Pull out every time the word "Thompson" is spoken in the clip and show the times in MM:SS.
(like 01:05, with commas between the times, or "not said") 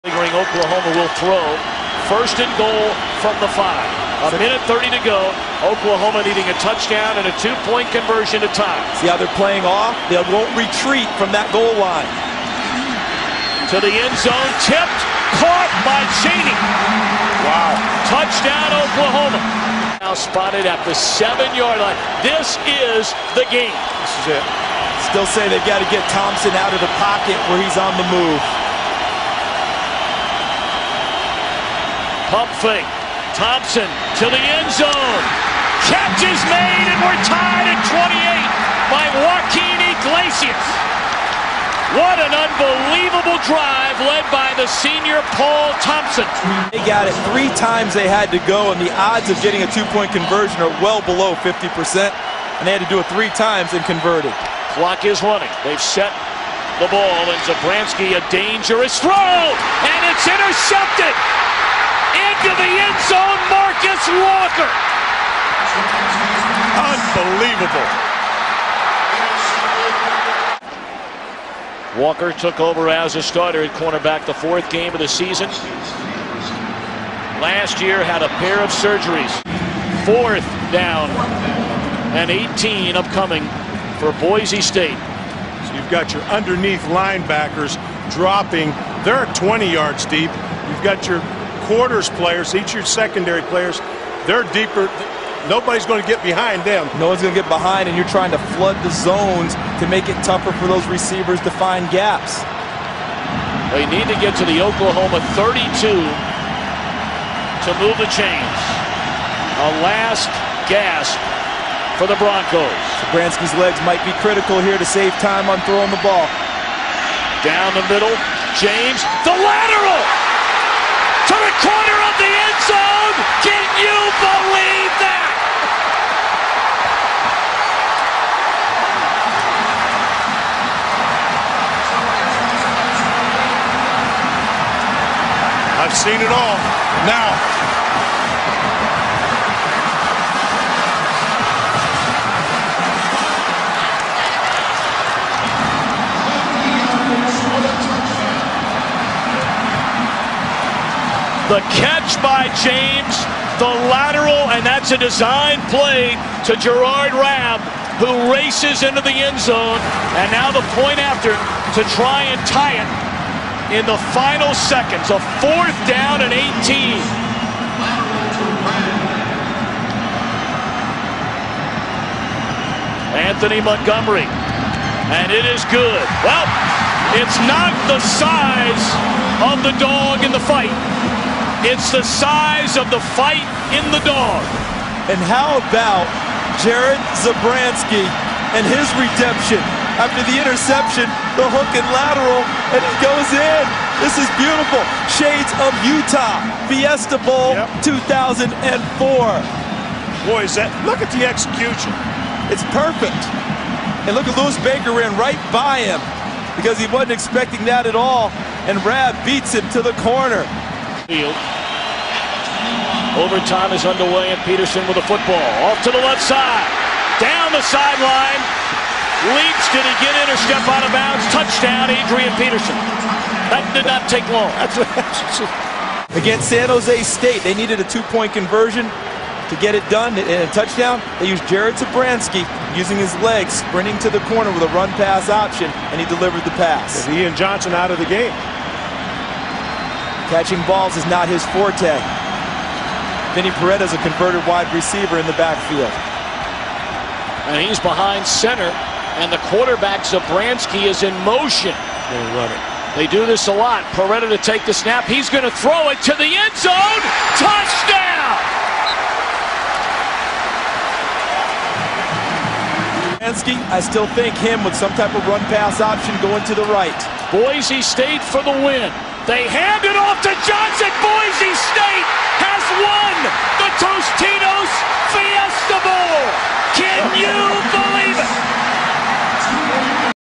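00:26, 00:33, 00:45.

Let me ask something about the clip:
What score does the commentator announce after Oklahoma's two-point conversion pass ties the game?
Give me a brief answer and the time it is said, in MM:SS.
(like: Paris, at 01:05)
28, at 00:37.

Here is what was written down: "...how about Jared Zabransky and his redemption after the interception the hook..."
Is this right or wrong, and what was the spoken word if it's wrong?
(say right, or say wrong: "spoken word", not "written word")
right.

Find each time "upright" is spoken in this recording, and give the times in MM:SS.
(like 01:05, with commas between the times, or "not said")
not said.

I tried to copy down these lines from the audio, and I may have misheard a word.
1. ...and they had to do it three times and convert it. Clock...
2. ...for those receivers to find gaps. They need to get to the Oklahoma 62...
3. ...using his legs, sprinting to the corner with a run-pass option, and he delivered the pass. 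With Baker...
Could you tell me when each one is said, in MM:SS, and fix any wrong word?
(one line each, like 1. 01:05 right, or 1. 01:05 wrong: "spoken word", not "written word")
1. 00:51 right
2. 01:40 wrong: "32", not "62"
3. 03:52 wrong: "Ian", not "Baker".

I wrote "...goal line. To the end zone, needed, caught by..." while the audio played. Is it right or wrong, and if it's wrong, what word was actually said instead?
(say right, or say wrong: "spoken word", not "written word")
wrong: "tipped", not "needed".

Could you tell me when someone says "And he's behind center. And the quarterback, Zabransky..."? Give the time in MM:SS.
04:07.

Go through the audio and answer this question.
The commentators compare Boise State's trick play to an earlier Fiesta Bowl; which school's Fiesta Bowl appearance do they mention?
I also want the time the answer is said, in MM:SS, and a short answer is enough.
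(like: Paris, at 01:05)
Utah, at 03:15.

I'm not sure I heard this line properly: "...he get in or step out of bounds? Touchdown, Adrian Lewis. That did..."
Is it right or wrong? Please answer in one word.
wrong.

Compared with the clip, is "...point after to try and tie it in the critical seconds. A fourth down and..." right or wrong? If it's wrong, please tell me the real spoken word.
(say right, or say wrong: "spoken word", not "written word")
wrong: "final", not "critical".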